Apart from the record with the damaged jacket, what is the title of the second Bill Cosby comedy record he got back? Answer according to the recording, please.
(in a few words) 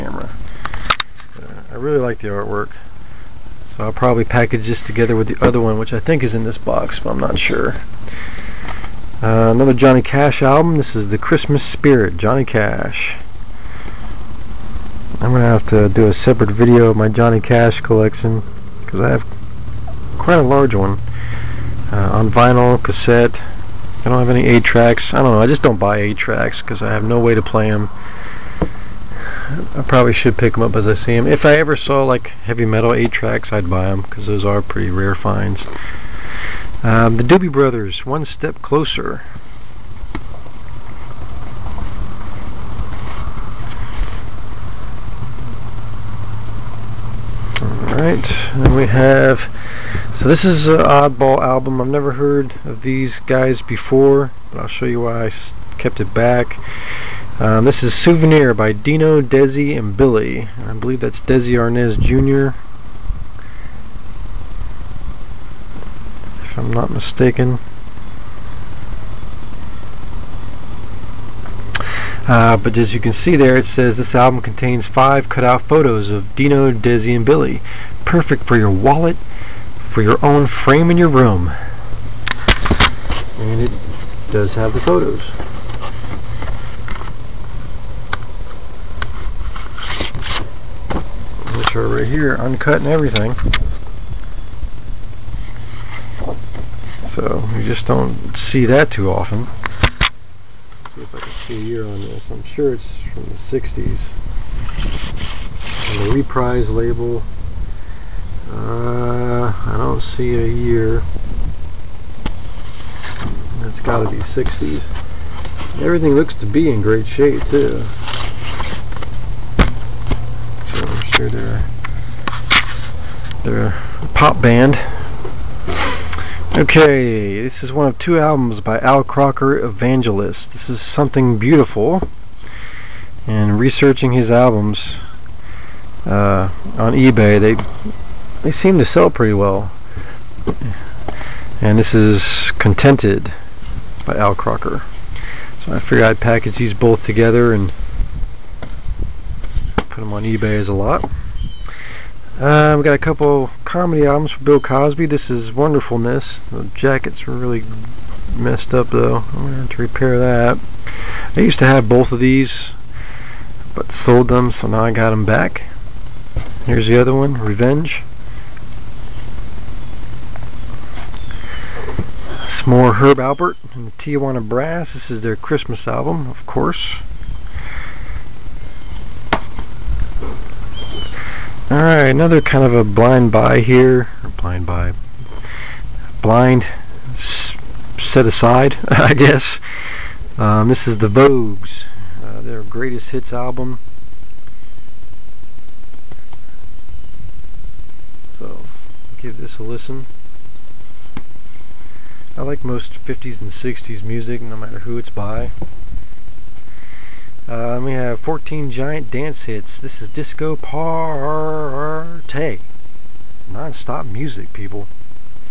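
Revenge.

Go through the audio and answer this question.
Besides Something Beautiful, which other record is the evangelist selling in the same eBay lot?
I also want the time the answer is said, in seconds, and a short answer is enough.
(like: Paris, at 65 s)
Contented, at 142 s.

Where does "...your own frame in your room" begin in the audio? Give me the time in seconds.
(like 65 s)
80 s.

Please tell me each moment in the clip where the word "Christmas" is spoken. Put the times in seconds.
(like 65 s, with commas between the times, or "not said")
11 s, 175 s.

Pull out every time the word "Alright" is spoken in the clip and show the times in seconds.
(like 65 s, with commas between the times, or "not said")
47 s, 181 s.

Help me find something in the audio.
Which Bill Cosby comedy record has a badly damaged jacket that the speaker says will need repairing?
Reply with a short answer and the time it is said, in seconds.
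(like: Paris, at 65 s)
Wonderfulness, at 155 s.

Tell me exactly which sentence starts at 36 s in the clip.
Um, the Doobie Brothers, One Step Closer.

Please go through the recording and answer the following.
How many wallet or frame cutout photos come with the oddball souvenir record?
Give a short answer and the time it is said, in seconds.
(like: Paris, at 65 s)
5, at 74 s.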